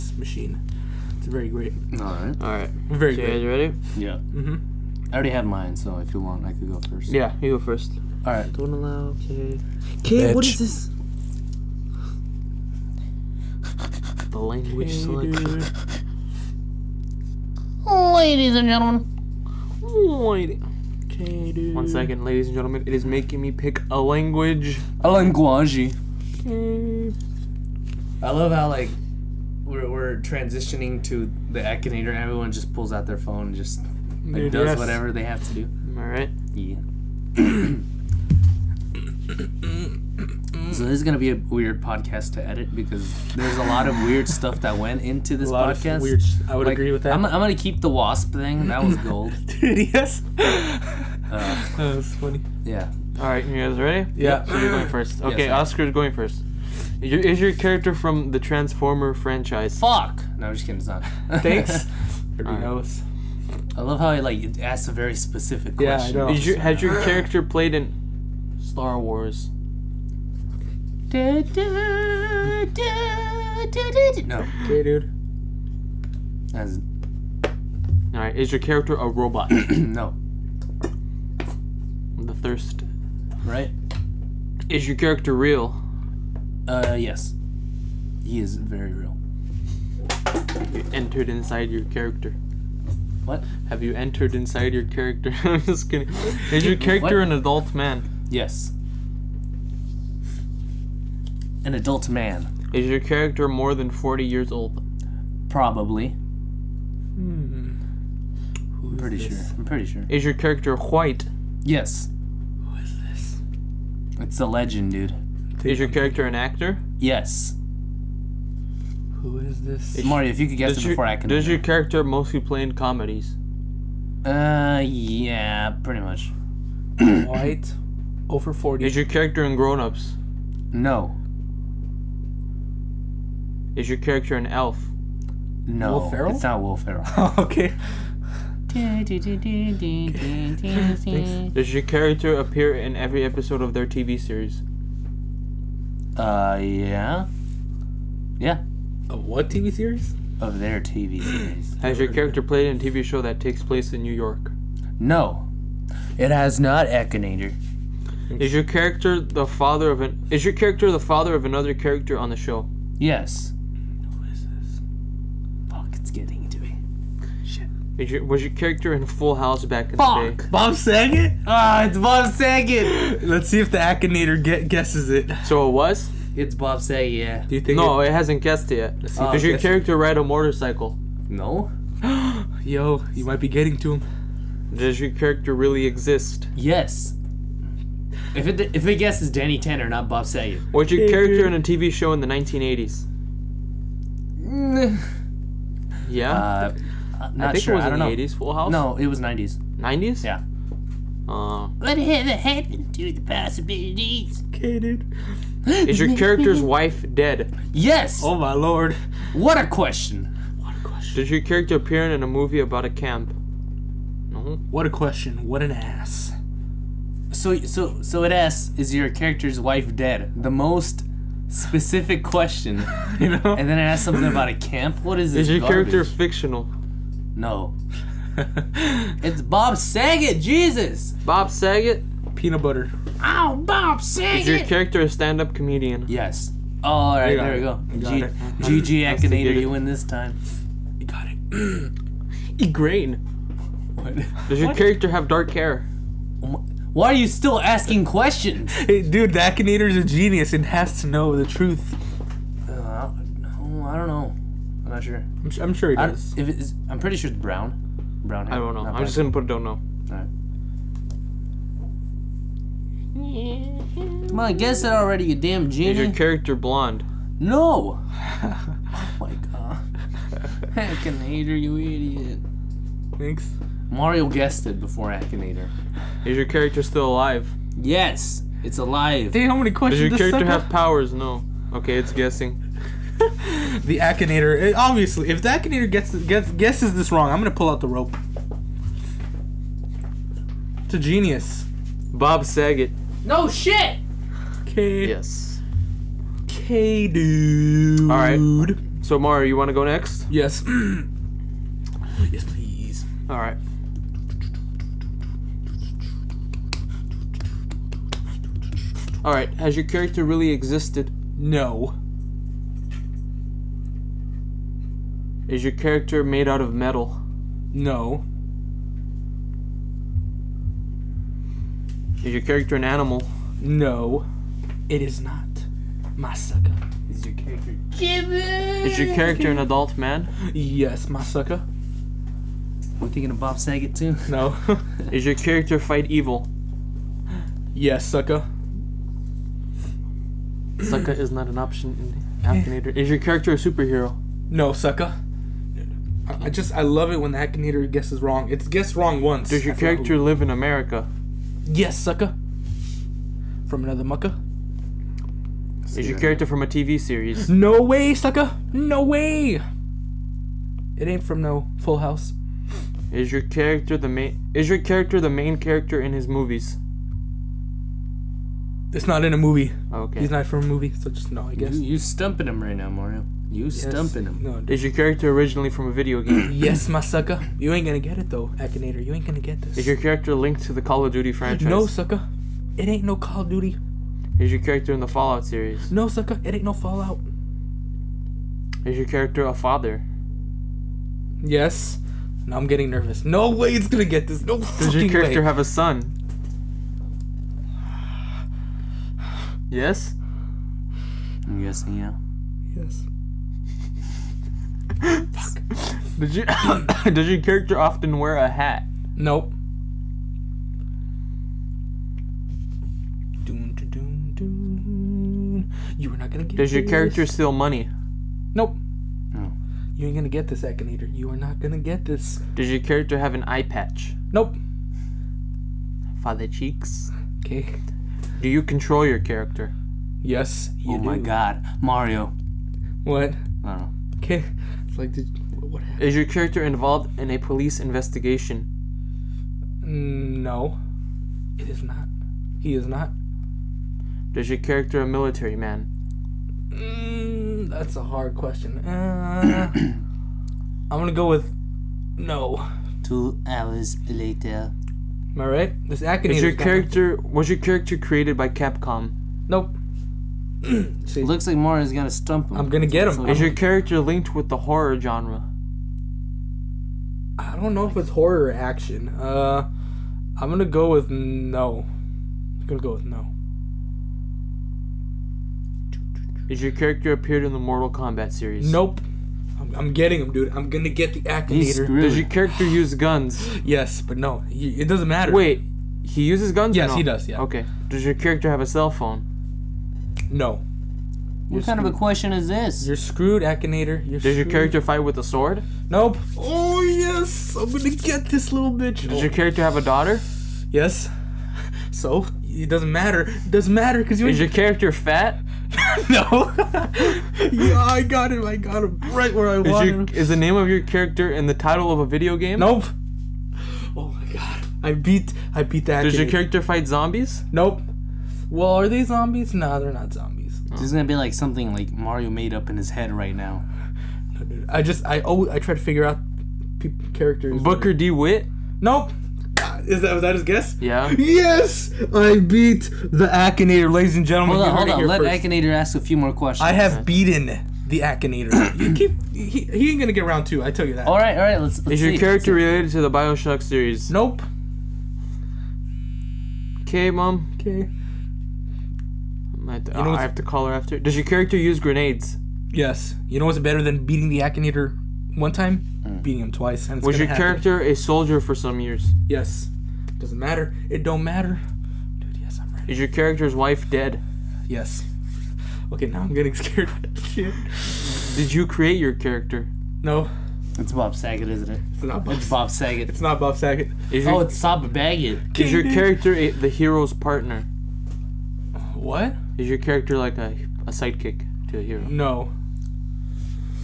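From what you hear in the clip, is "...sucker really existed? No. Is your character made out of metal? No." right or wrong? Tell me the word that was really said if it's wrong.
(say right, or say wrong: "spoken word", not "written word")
wrong: "character", not "sucker".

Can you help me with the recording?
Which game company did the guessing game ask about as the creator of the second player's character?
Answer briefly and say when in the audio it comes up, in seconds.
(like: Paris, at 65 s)
Capcom, at 458 s.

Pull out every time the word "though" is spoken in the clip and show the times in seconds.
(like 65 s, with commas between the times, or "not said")
378 s.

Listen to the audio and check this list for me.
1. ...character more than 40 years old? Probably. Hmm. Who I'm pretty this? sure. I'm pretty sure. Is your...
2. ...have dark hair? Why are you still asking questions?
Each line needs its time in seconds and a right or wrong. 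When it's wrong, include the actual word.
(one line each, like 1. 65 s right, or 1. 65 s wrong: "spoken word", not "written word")
1. 103 s right
2. 245 s right.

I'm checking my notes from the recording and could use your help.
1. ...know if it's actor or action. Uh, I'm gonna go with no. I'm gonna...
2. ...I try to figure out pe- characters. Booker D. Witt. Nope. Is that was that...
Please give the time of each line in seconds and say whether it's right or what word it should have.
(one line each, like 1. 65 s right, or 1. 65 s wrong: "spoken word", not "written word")
1. 467 s wrong: "horror", not "actor"
2. 525 s right.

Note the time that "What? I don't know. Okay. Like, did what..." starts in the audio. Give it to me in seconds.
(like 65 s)
433 s.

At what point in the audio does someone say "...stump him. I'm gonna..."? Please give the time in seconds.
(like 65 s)
462 s.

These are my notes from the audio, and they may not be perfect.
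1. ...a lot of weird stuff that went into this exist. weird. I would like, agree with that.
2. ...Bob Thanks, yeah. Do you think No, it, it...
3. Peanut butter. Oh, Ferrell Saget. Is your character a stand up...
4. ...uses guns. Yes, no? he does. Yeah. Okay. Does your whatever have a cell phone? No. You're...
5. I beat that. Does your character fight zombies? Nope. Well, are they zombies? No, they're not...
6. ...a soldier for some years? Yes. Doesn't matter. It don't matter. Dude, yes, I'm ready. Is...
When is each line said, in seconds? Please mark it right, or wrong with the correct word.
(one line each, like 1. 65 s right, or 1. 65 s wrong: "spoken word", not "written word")
1. 43 s wrong: "podcast", not "exist"
2. 176 s wrong: "Saget", not "Thanks"
3. 232 s wrong: "Bob", not "Ferrell"
4. 486 s wrong: "character", not "whatever"
5. 515 s right
6. 557 s right.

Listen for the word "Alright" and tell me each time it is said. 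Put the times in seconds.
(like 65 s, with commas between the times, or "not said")
78 s, 260 s.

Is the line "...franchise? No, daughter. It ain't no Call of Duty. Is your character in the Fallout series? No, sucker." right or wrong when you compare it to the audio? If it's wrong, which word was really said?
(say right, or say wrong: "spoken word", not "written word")
wrong: "sucker", not "daughter".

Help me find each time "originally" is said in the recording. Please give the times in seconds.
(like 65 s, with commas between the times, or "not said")
375 s.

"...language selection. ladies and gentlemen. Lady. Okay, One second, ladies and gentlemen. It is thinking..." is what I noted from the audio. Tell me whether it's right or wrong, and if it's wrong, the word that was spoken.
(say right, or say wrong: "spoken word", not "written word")
wrong: "making", not "thinking".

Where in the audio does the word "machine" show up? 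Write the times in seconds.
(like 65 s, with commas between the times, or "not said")
0 s.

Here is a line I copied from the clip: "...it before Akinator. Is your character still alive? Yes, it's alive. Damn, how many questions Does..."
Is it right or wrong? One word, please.
right.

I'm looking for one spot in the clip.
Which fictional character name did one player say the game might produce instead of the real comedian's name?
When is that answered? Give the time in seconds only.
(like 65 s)
189 s.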